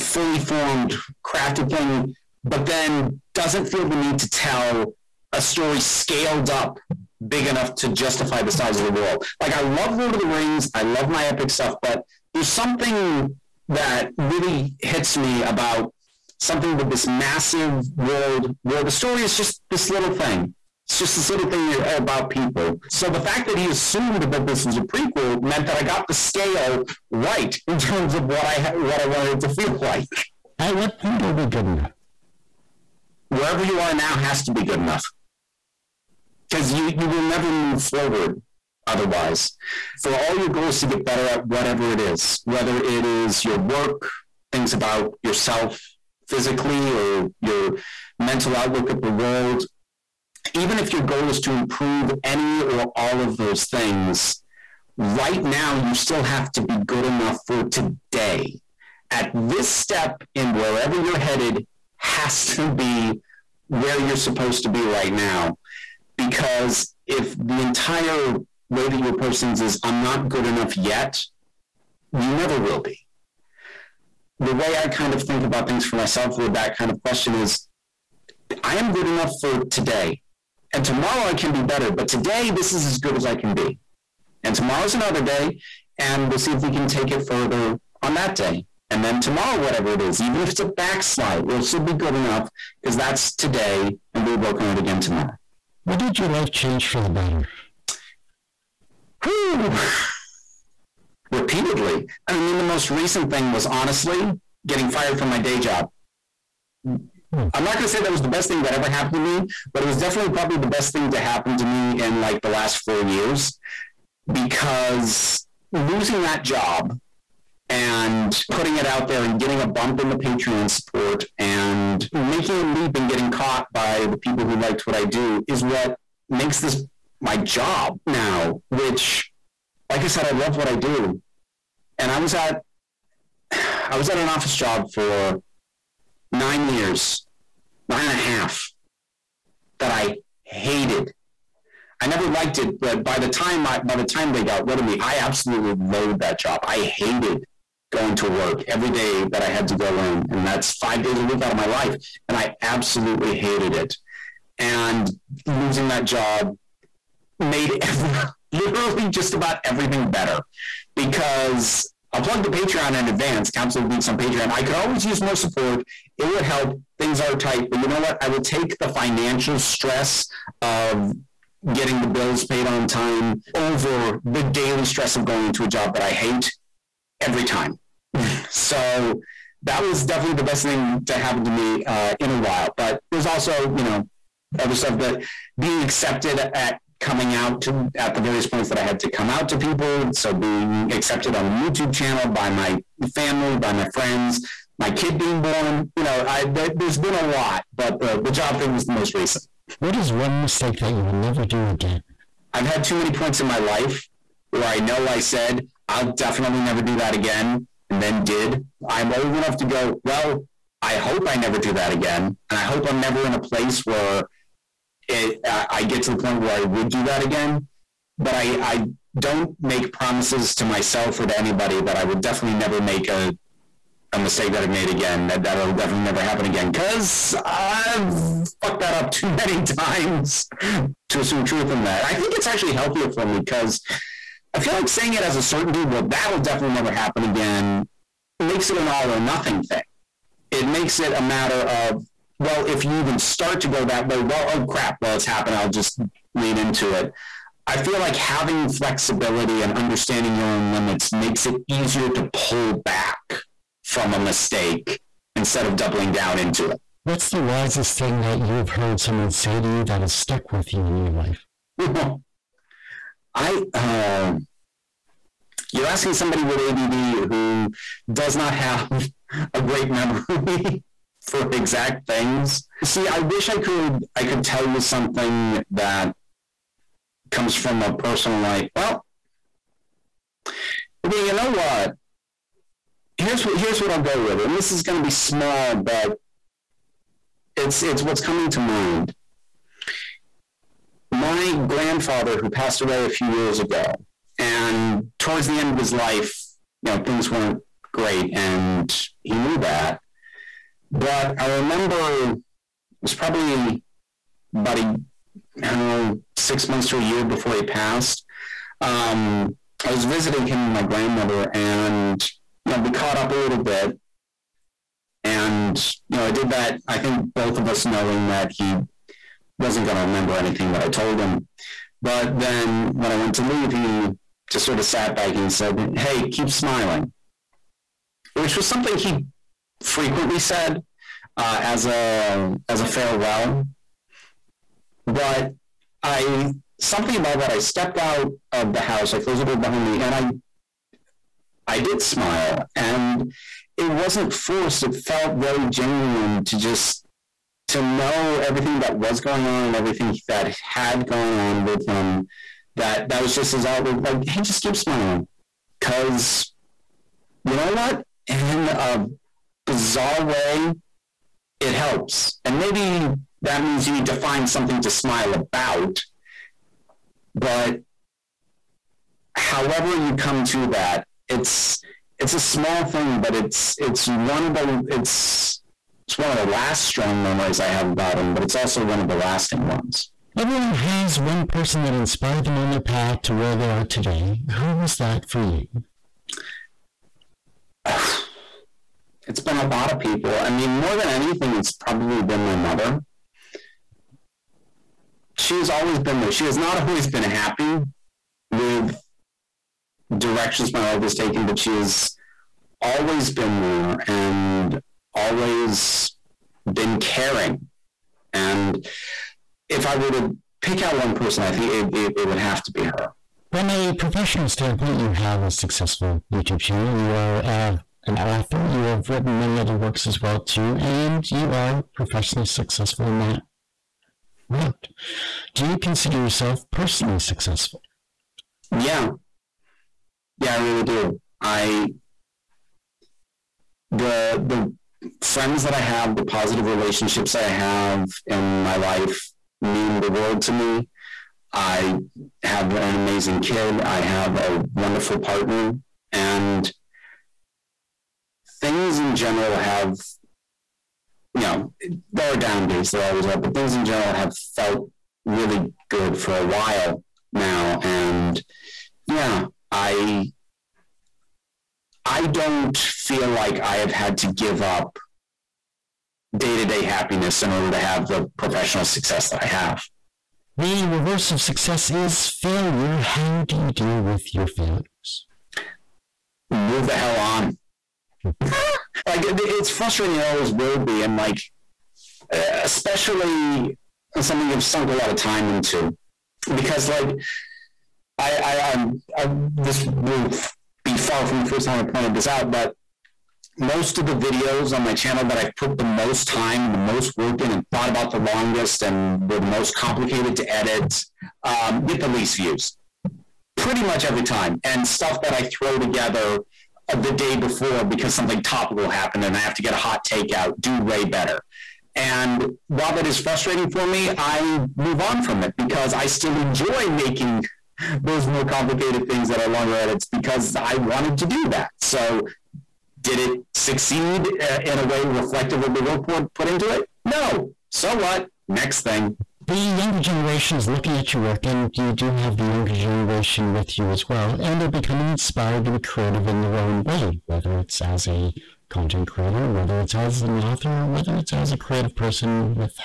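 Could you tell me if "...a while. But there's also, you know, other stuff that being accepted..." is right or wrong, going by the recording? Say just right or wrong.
right.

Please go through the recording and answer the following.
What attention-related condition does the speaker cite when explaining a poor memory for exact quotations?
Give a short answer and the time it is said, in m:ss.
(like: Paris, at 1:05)
ADD, at 4:26.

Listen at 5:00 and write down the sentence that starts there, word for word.
But I remember it was probably about a oh, six months to a year before he passed.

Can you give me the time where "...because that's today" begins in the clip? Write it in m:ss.
1:32.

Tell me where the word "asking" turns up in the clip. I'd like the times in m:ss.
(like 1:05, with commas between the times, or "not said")
4:25.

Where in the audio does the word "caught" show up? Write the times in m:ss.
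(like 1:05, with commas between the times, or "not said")
2:03, 5:12.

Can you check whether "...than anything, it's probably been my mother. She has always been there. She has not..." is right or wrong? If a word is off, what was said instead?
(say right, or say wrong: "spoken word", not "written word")
right.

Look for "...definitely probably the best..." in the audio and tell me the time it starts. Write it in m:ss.
1:49.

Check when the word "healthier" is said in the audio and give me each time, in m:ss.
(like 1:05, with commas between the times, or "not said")
3:52.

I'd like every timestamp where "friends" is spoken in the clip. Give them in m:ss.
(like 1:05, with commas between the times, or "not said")
3:13, 7:15.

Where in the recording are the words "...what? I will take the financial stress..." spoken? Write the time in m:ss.
2:47.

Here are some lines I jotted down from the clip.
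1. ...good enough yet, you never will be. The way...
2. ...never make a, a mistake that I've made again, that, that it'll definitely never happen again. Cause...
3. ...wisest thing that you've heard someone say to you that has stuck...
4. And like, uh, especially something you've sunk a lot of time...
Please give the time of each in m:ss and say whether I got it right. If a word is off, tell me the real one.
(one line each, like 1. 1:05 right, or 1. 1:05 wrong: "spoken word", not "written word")
1. 1:10 right
2. 3:42 right
3. 4:17 right
4. 8:01 right.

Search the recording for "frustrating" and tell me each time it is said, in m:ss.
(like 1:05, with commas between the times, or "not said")
7:59, 8:33.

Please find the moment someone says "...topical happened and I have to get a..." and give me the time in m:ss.
8:28.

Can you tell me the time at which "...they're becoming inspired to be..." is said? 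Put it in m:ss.
8:54.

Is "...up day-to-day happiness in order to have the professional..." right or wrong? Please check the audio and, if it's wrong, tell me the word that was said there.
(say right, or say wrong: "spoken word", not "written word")
right.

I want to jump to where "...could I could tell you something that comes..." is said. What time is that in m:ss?
4:33.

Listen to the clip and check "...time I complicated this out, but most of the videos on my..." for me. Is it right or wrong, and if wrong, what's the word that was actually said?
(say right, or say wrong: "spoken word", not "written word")
wrong: "pointed", not "complicated".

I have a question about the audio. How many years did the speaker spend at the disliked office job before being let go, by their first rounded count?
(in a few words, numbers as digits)
9.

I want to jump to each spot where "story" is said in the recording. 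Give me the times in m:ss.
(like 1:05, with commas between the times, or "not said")
0:05, 0:18.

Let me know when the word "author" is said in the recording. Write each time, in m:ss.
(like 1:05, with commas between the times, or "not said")
6:58, 9:00.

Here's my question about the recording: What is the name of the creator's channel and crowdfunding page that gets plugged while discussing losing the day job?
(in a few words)
Council of Geeks.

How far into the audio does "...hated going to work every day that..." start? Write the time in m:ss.
2:26.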